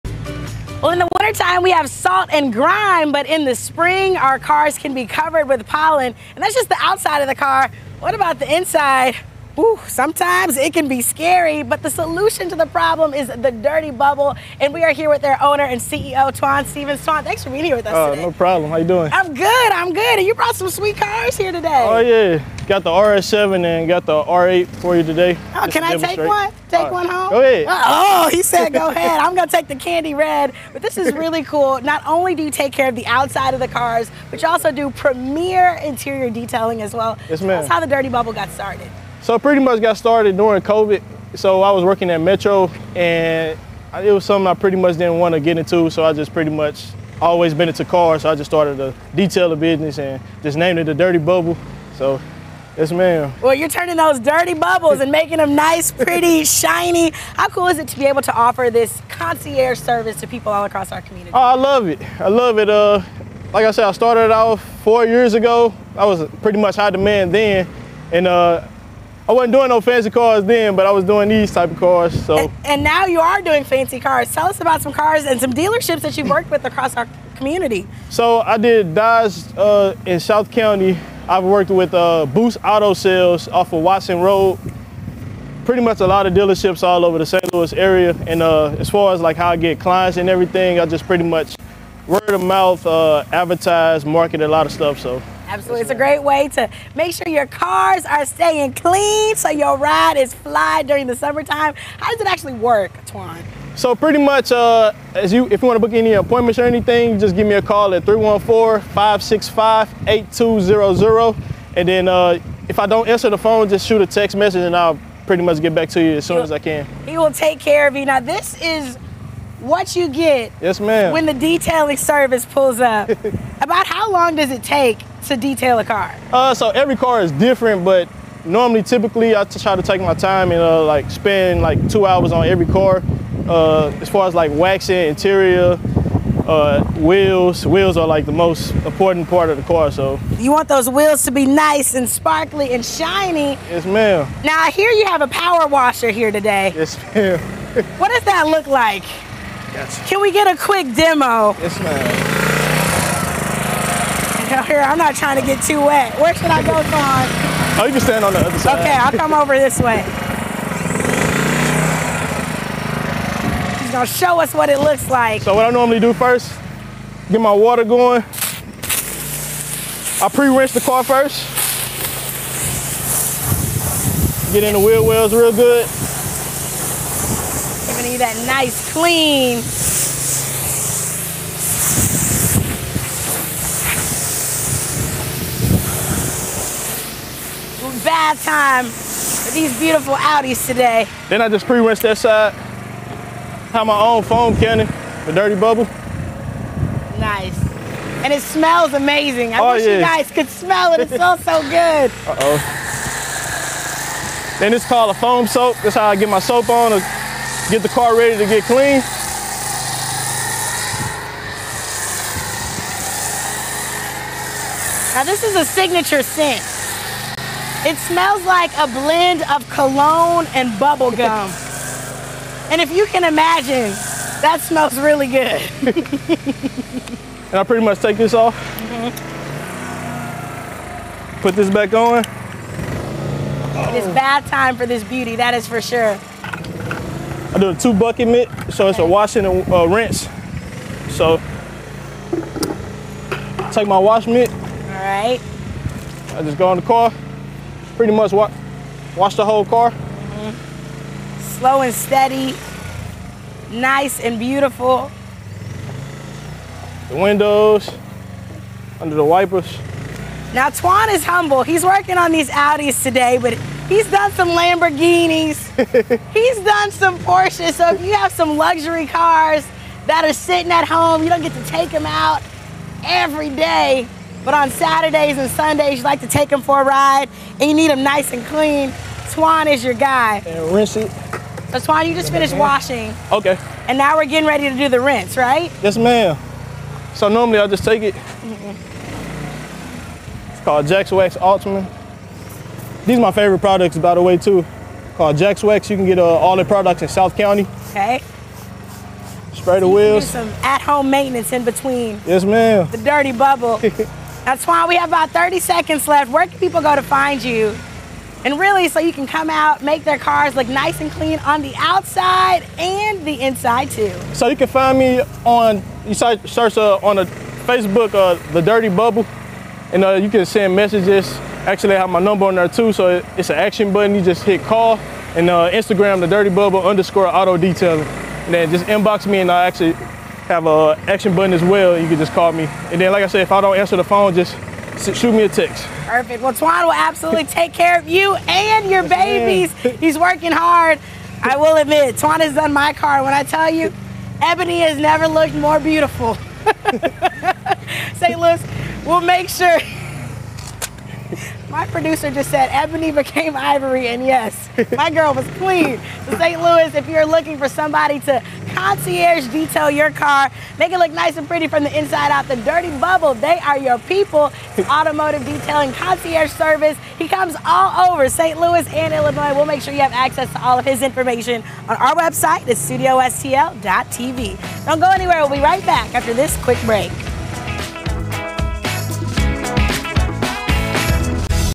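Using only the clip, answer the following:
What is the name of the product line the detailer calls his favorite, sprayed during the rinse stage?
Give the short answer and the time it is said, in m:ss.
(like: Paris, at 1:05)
Jax Wax Ultimate, at 4:50.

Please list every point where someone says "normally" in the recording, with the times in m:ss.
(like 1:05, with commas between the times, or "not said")
2:08, 2:45, 4:47.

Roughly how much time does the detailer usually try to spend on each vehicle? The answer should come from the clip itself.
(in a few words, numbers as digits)
2 hours.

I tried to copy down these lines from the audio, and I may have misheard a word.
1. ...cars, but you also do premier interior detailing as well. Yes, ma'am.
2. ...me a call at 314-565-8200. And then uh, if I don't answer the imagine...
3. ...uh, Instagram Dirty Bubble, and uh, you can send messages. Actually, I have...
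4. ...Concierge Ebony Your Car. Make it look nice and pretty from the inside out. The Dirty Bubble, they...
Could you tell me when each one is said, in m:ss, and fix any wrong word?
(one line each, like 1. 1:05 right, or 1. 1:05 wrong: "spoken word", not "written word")
1. 0:33 right
2. 1:47 wrong: "phone", not "imagine"
3. 5:18 wrong: "The", not "Instagram"
4. 5:58 wrong: "Detail", not "Ebony".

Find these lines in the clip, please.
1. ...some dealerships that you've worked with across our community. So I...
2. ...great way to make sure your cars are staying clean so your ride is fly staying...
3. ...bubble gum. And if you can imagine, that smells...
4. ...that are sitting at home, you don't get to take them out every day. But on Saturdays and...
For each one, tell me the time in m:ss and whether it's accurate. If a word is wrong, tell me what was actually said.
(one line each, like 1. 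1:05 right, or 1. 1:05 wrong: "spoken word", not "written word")
1. 1:15 right
2. 1:35 wrong: "during", not "staying"
3. 3:40 right
4. 4:30 right.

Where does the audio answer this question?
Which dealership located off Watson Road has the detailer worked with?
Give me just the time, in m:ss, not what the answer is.
1:22.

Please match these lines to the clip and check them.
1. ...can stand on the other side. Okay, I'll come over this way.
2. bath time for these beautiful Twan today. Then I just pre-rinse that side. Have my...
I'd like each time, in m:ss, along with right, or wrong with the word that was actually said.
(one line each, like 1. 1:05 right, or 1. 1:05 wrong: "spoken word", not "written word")
1. 2:37 right
2. 3:08 wrong: "Audis", not "Twan".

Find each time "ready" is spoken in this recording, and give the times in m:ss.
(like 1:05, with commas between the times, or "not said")
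3:28, 4:44.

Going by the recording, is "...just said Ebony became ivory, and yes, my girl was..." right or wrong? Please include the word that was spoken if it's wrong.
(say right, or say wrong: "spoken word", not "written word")
right.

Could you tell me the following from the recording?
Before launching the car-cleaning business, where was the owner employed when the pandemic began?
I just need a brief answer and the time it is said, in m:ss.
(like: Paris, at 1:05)
Metro, at 0:42.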